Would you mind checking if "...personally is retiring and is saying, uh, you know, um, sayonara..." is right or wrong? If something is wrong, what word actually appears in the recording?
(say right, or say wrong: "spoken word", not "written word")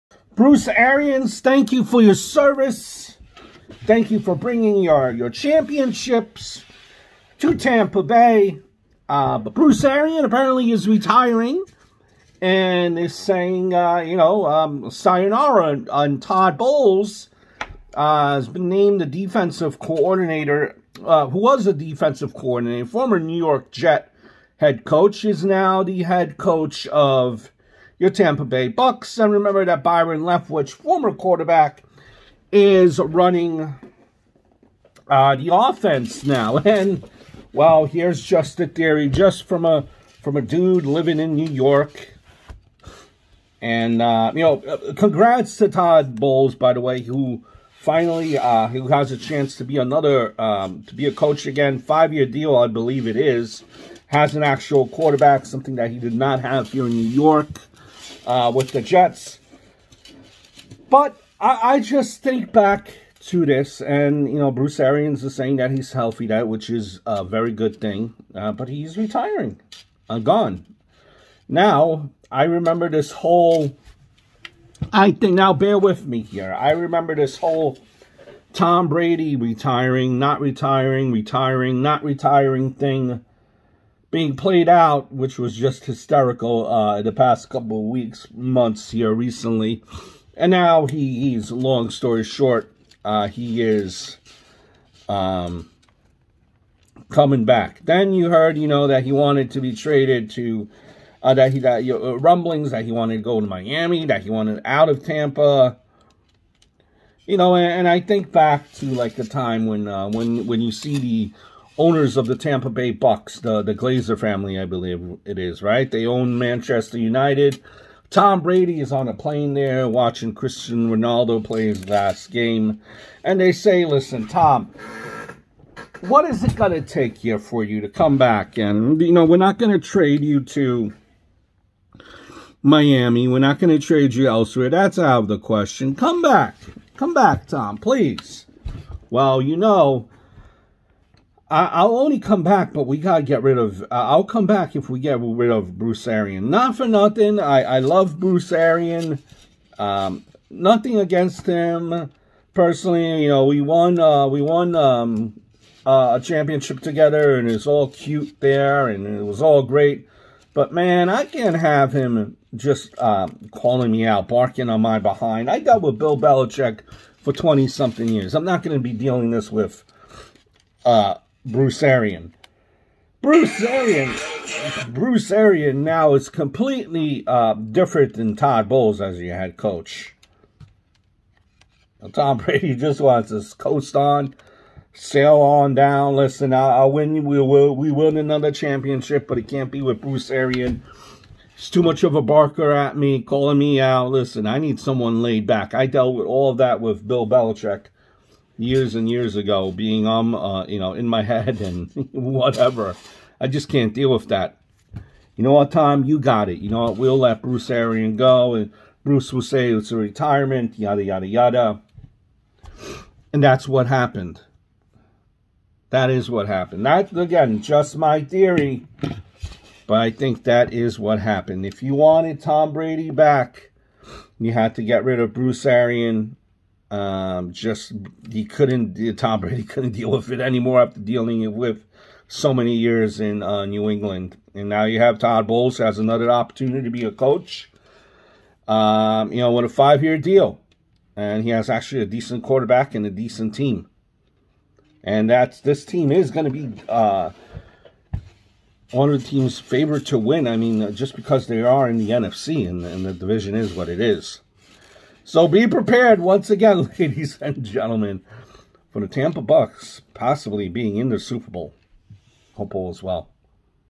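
wrong: "apparently", not "personally".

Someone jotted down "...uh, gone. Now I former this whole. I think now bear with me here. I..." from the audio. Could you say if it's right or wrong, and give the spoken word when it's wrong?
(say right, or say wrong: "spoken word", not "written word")
wrong: "remember", not "former".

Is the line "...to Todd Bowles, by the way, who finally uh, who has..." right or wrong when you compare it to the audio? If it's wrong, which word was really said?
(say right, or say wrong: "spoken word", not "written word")
right.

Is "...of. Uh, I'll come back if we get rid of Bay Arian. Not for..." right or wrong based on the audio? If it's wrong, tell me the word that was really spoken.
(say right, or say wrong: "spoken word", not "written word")
wrong: "Bruce", not "Bay".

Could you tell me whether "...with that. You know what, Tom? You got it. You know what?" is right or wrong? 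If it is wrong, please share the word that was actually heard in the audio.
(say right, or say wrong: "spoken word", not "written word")
right.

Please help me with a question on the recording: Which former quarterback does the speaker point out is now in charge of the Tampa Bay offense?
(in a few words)
Byron Leftwich.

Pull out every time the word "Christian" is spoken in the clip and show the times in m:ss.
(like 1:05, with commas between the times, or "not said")
2:00.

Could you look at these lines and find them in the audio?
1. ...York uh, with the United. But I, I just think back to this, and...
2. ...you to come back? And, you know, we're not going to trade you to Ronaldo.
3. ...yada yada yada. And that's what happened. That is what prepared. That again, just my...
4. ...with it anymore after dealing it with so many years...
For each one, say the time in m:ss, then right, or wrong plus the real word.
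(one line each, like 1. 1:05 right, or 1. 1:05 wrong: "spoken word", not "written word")
1. 0:57 wrong: "Jets", not "United"
2. 2:07 wrong: "Miami", not "Ronaldo"
3. 3:30 wrong: "happened", not "prepared"
4. 3:50 right.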